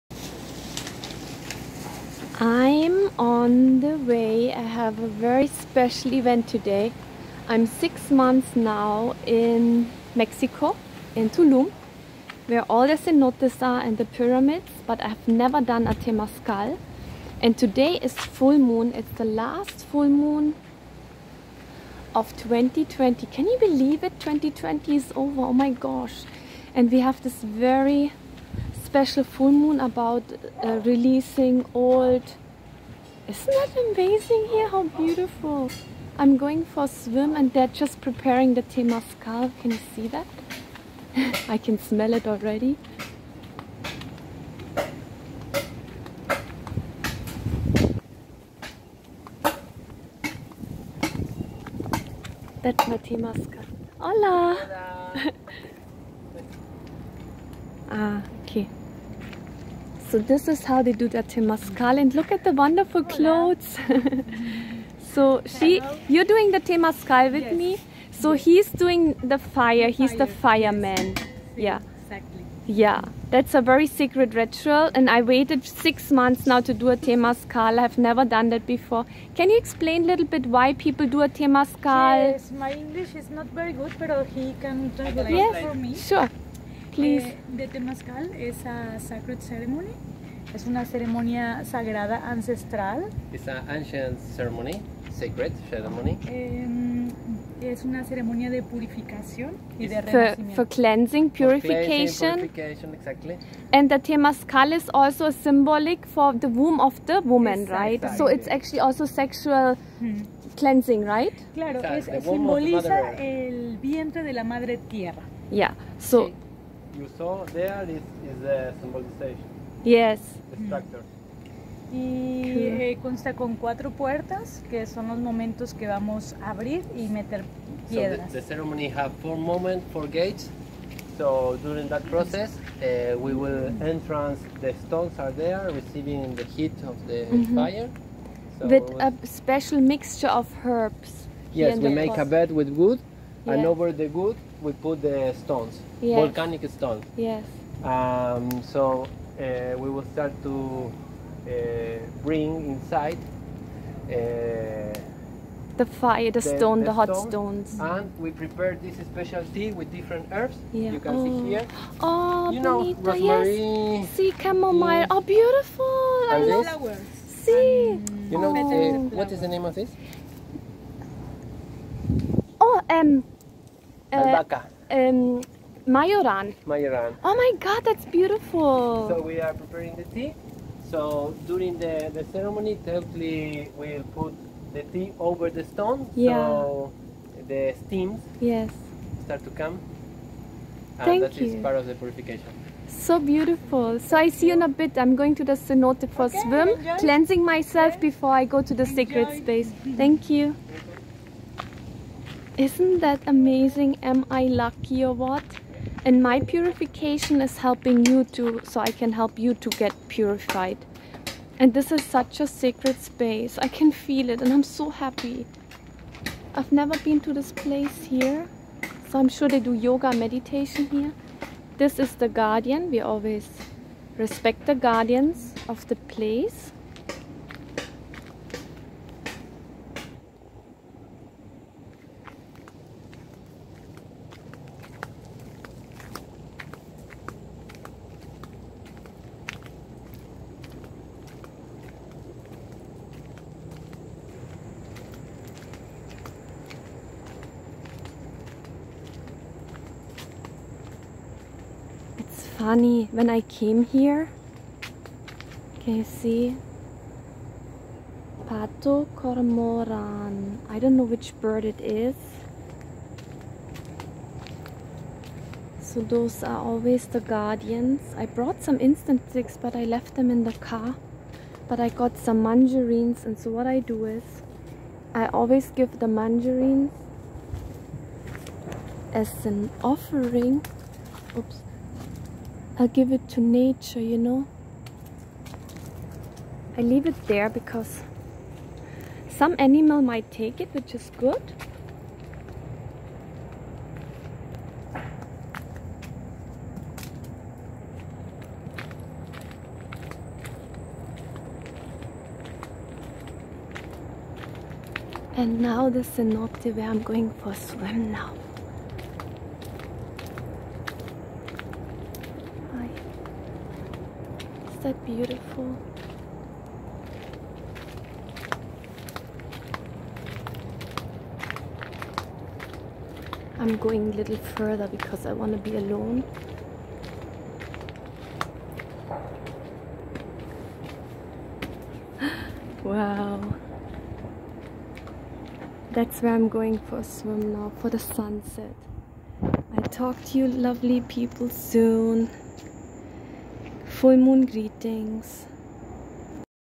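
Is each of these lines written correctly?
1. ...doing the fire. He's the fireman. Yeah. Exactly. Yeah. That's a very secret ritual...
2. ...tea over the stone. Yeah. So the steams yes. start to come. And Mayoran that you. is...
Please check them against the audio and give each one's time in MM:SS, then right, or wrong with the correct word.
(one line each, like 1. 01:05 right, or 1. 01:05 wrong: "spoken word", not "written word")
1. 01:08 right
2. 03:04 wrong: "Thank", not "Mayoran".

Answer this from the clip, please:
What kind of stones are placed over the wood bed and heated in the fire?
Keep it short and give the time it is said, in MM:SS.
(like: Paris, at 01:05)
Volcanic stones, at 02:26.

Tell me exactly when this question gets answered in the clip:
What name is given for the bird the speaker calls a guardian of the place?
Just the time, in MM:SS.
04:18.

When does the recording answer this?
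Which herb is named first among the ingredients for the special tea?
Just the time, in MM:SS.
02:42.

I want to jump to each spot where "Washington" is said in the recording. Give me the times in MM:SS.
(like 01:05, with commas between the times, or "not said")
not said.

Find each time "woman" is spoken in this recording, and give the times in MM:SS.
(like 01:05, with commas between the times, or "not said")
01:47.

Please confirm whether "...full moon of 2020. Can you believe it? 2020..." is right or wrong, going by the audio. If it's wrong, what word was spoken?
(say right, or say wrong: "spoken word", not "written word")
right.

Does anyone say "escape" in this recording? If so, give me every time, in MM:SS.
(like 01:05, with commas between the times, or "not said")
not said.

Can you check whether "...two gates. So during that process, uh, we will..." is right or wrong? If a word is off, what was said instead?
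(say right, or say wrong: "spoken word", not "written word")
wrong: "four", not "two".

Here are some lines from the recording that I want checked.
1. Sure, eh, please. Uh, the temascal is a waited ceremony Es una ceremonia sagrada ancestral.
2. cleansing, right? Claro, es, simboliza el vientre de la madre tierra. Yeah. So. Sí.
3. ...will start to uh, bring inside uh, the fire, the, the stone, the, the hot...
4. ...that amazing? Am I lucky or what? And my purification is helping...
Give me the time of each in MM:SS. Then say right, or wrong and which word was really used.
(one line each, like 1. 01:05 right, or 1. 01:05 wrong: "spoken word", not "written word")
1. 01:25 wrong: "sacred", not "waited"
2. 01:50 right
3. 02:29 right
4. 03:22 right.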